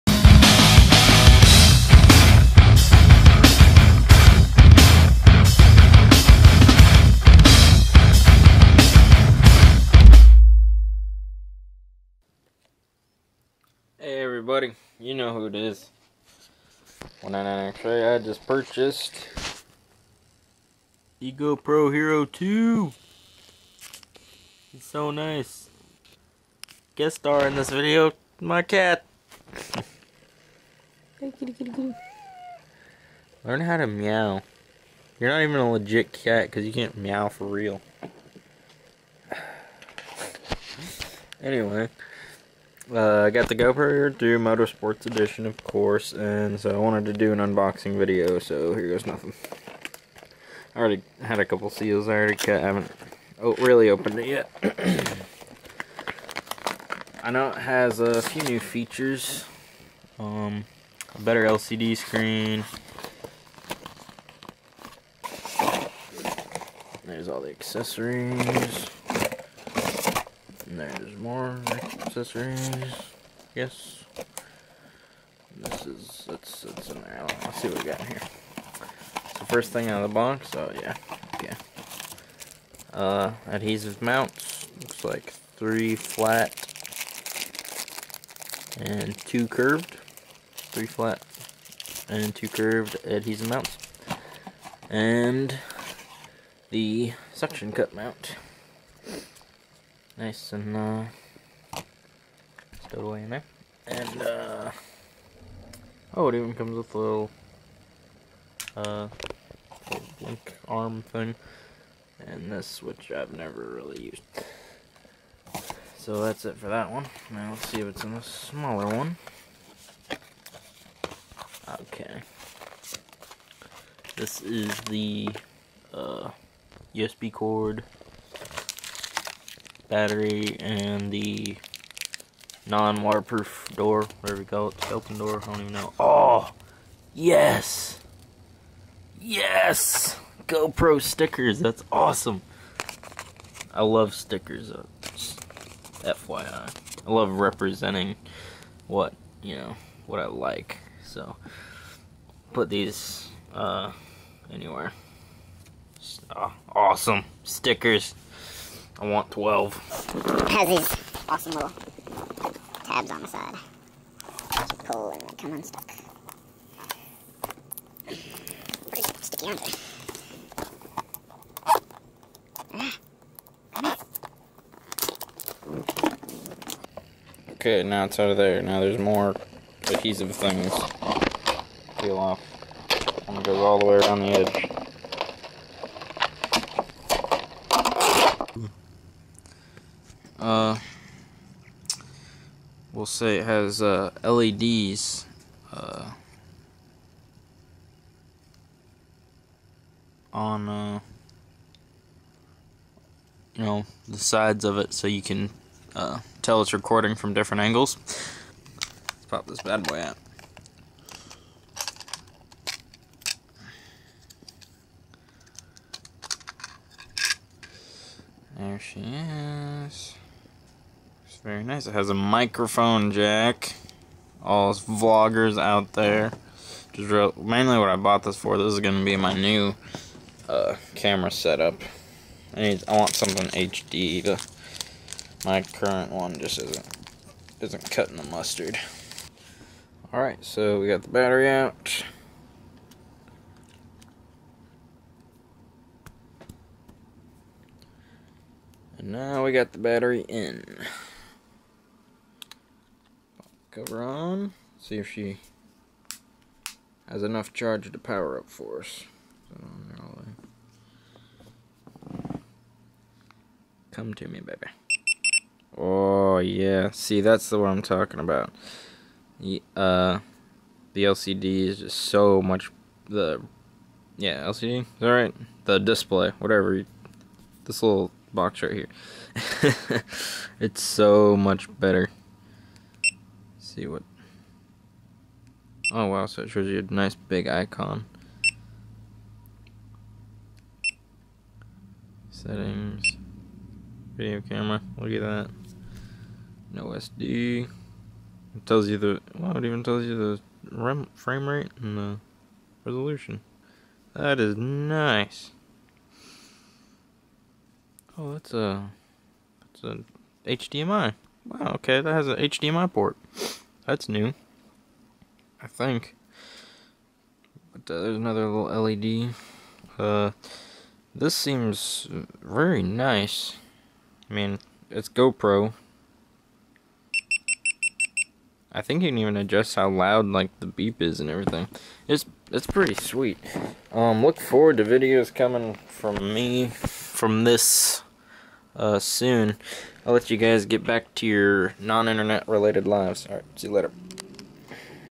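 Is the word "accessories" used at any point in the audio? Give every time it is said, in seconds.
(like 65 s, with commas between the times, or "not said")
67 s, 72 s.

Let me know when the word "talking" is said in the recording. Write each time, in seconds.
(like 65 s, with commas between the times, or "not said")
267 s.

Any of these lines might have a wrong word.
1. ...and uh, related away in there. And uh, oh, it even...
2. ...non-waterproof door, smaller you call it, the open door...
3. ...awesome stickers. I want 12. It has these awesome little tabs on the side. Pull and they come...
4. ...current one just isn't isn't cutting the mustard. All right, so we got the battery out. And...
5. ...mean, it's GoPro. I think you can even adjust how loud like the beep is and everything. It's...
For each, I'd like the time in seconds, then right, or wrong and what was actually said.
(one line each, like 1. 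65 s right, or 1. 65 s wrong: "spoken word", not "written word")
1. 100 s wrong: "stowed", not "related"
2. 132 s wrong: "whatever", not "smaller"
3. 156 s right
4. 235 s right
5. 324 s right.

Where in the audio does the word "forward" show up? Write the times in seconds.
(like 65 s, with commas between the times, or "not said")
334 s.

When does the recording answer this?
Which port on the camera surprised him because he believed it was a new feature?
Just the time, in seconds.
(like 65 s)
312 s.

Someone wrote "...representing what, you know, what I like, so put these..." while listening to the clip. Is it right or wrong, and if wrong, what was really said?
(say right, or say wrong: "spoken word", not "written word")
right.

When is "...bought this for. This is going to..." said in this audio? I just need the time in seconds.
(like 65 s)
227 s.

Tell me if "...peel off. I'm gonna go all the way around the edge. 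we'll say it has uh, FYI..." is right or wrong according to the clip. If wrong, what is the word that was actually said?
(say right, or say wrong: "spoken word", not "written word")
wrong: "LEDs", not "FYI".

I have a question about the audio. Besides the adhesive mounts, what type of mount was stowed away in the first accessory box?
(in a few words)
suction cup mount.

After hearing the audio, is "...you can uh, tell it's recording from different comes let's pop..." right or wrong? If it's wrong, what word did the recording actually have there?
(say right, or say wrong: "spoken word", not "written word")
wrong: "angles", not "comes".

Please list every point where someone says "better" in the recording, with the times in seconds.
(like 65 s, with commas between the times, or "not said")
61 s, 281 s.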